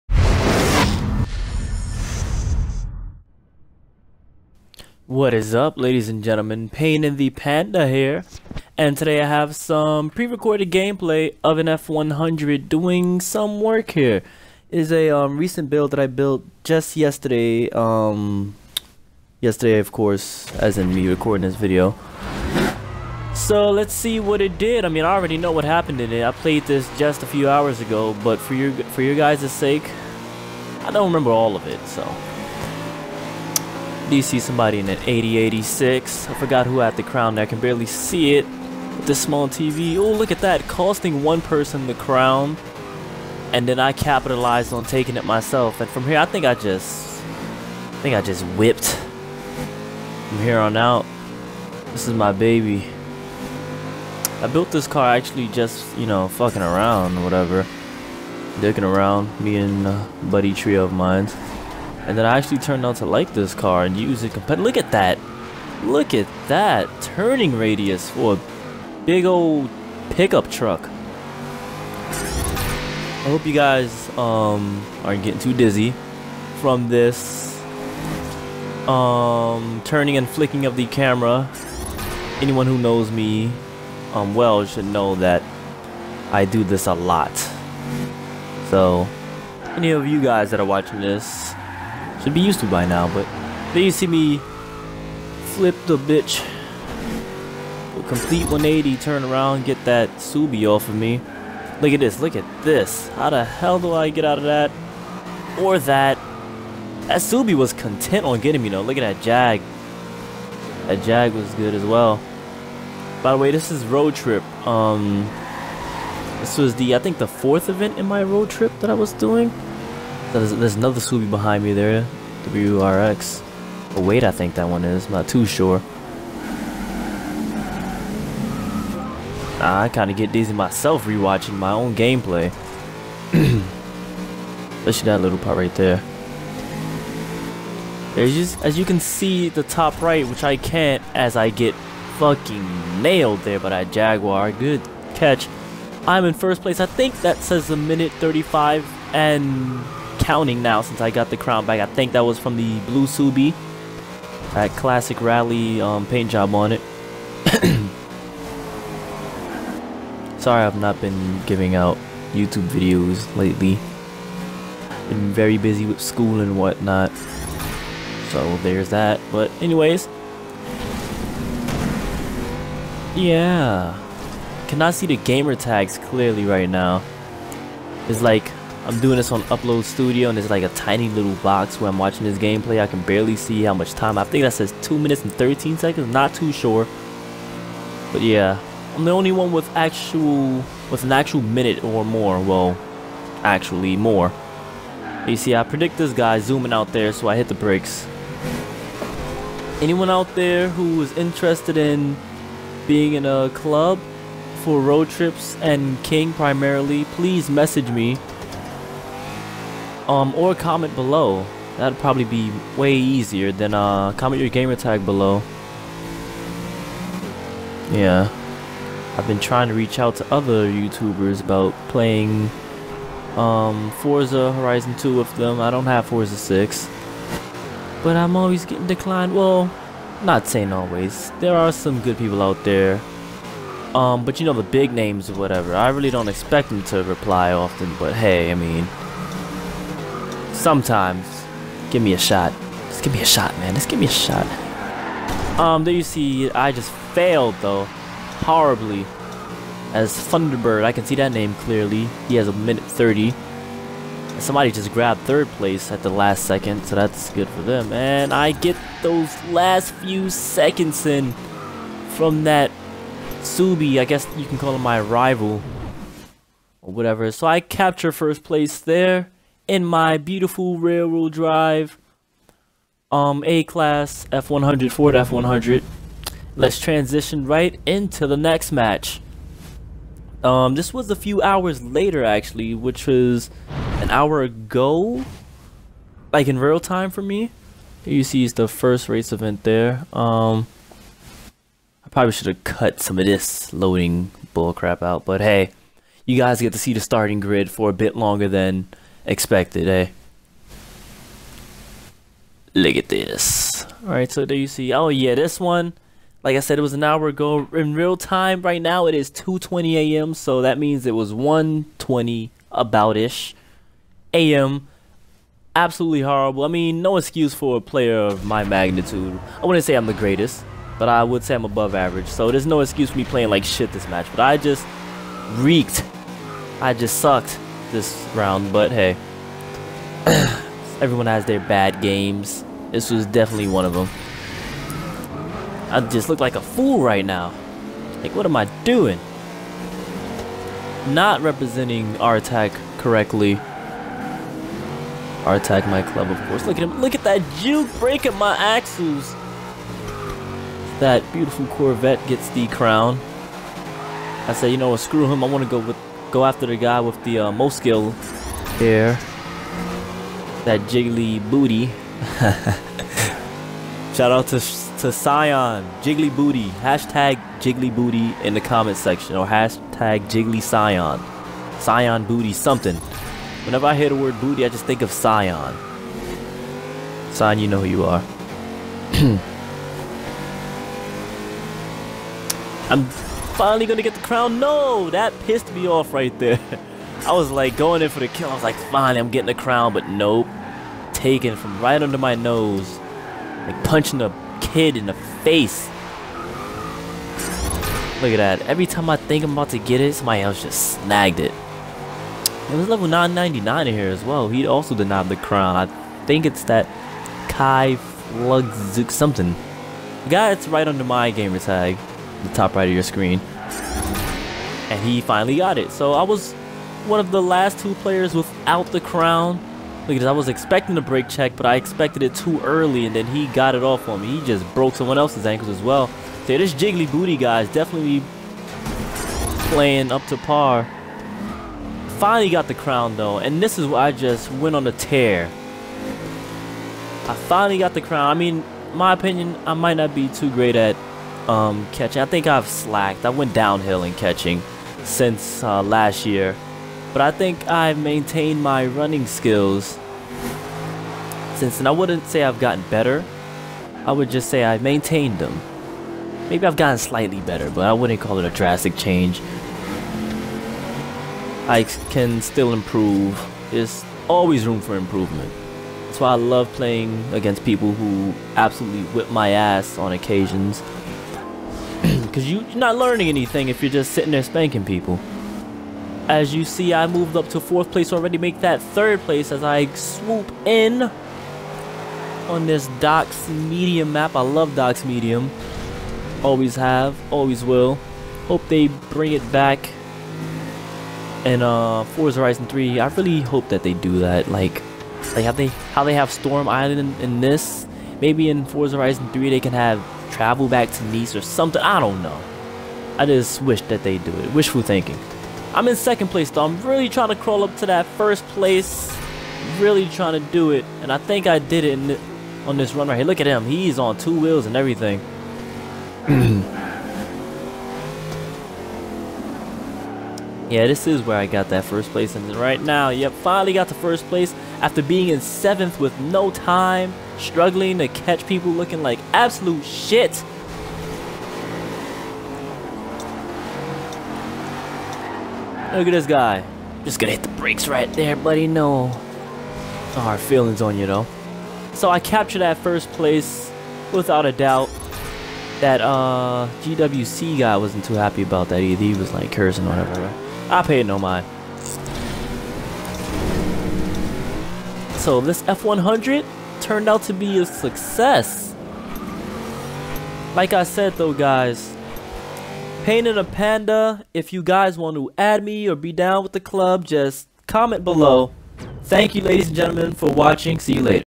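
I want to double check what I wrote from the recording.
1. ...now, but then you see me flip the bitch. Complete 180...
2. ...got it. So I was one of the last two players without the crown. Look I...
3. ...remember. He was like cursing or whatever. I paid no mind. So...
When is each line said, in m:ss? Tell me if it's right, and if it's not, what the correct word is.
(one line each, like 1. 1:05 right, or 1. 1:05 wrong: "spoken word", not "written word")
1. 1:32 right
2. 6:55 right
3. 9:08 wrong: "either", not "remember".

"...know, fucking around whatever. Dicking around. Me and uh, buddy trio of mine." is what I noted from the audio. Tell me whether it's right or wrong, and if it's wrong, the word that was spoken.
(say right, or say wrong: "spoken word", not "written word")
right.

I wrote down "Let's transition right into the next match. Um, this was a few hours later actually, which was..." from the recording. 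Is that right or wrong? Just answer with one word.
right.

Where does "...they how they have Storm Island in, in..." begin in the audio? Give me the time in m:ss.
8:15.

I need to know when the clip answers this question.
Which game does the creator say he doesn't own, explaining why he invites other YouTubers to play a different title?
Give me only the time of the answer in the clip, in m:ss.
3:46.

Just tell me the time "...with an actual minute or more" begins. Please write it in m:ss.
3:10.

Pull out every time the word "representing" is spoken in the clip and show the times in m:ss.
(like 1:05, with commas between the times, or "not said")
5:41.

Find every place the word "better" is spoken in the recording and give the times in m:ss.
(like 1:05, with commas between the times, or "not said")
7:32, 7:37.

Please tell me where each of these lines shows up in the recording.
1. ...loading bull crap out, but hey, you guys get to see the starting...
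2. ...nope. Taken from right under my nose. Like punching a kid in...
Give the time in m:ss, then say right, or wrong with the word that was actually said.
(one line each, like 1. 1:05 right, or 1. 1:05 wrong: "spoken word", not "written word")
1. 4:53 right
2. 6:30 right.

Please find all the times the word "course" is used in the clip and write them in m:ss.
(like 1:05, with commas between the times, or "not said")
0:19, 5:46.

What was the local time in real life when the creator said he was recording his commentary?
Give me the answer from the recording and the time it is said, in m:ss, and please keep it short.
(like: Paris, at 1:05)
2:20 a.m., at 5:09.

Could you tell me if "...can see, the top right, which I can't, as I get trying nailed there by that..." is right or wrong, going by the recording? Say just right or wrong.
wrong.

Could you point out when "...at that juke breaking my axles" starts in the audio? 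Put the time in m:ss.
5:47.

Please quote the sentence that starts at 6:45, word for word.
I think it's that Kai Flugzuk something.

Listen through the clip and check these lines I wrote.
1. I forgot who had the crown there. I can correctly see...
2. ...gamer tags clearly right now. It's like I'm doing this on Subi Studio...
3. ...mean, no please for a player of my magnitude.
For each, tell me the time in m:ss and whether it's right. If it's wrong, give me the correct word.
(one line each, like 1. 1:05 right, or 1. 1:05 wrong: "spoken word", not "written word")
1. 0:36 wrong: "barely", not "correctly"
2. 2:55 wrong: "Upload", not "Subi"
3. 5:16 wrong: "excuse", not "please".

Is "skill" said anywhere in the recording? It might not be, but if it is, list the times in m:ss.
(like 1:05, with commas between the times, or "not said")
5:57, 7:29.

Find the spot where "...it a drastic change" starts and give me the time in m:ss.
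7:38.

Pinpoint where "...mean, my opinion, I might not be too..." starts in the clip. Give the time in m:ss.
7:18.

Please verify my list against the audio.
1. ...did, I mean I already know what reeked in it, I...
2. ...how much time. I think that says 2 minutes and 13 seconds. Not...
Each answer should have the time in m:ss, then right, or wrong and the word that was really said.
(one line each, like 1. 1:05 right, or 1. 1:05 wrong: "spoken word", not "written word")
1. 0:24 wrong: "happened", not "reeked"
2. 3:03 right.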